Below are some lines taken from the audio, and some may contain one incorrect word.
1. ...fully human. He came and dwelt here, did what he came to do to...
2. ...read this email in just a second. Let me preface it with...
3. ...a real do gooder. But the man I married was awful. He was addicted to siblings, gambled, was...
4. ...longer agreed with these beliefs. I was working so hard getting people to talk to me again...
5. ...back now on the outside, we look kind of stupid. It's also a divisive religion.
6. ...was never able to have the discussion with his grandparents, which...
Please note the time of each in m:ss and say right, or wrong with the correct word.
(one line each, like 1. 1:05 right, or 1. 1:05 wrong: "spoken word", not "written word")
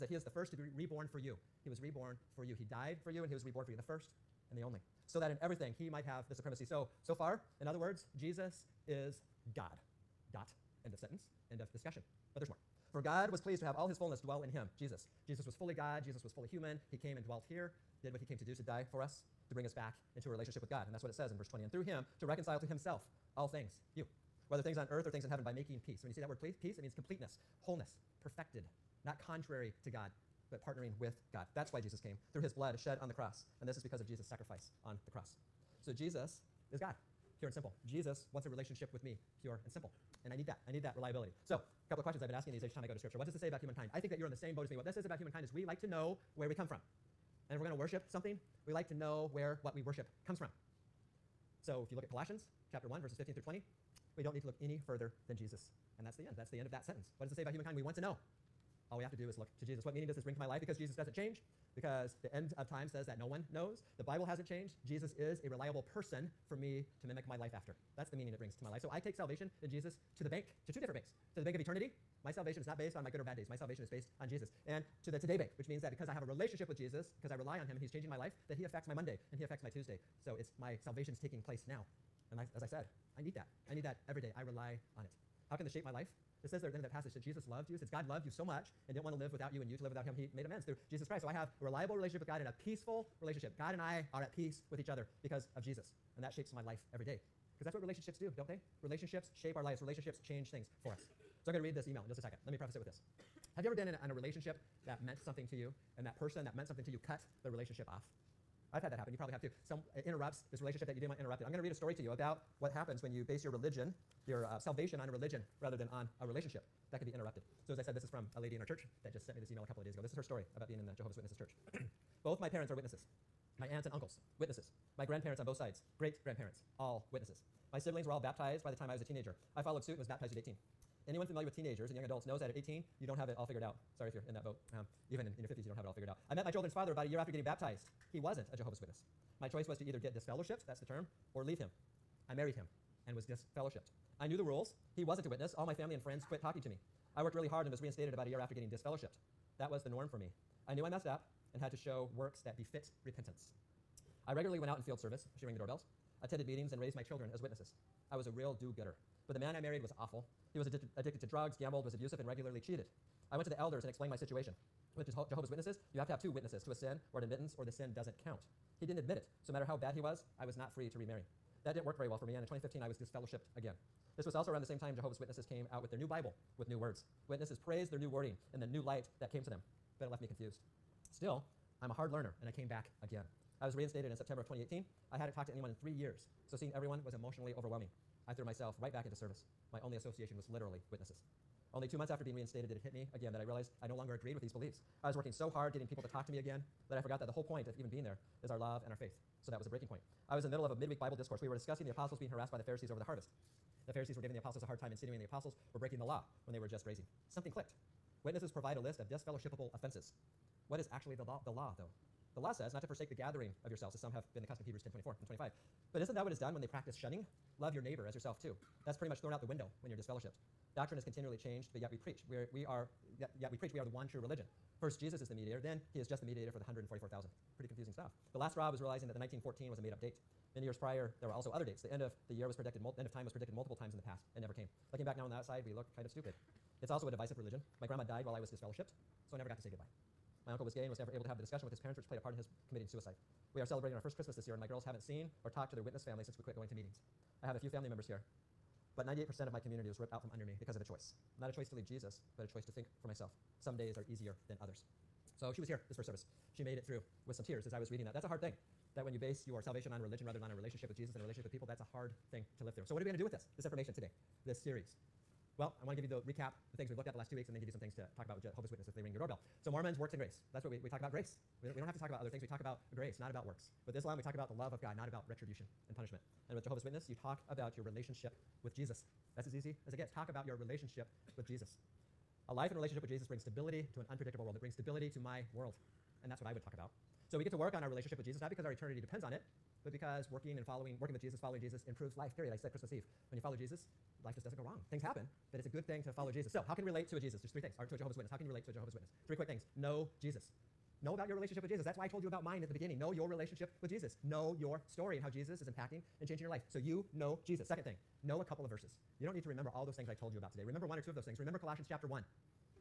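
1. 0:16 right
2. 1:41 right
3. 2:38 wrong: "drugs", not "siblings"
4. 3:13 right
5. 3:55 right
6. 4:00 wrong: "parents", not "grandparents".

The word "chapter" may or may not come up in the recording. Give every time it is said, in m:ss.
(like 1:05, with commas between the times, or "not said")
0:52, 5:11.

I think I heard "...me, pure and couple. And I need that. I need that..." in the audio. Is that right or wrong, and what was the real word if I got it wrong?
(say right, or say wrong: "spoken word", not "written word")
wrong: "simple", not "couple".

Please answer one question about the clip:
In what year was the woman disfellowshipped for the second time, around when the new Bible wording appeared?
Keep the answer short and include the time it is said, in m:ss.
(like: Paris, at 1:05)
2015, at 2:52.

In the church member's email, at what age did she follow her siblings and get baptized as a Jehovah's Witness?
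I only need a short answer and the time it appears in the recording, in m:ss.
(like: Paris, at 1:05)
18, at 2:10.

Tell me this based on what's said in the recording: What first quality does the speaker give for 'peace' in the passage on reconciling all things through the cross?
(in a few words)
completeness.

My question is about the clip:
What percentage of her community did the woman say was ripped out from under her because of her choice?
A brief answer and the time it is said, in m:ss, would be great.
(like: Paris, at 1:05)
98%, at 4:09.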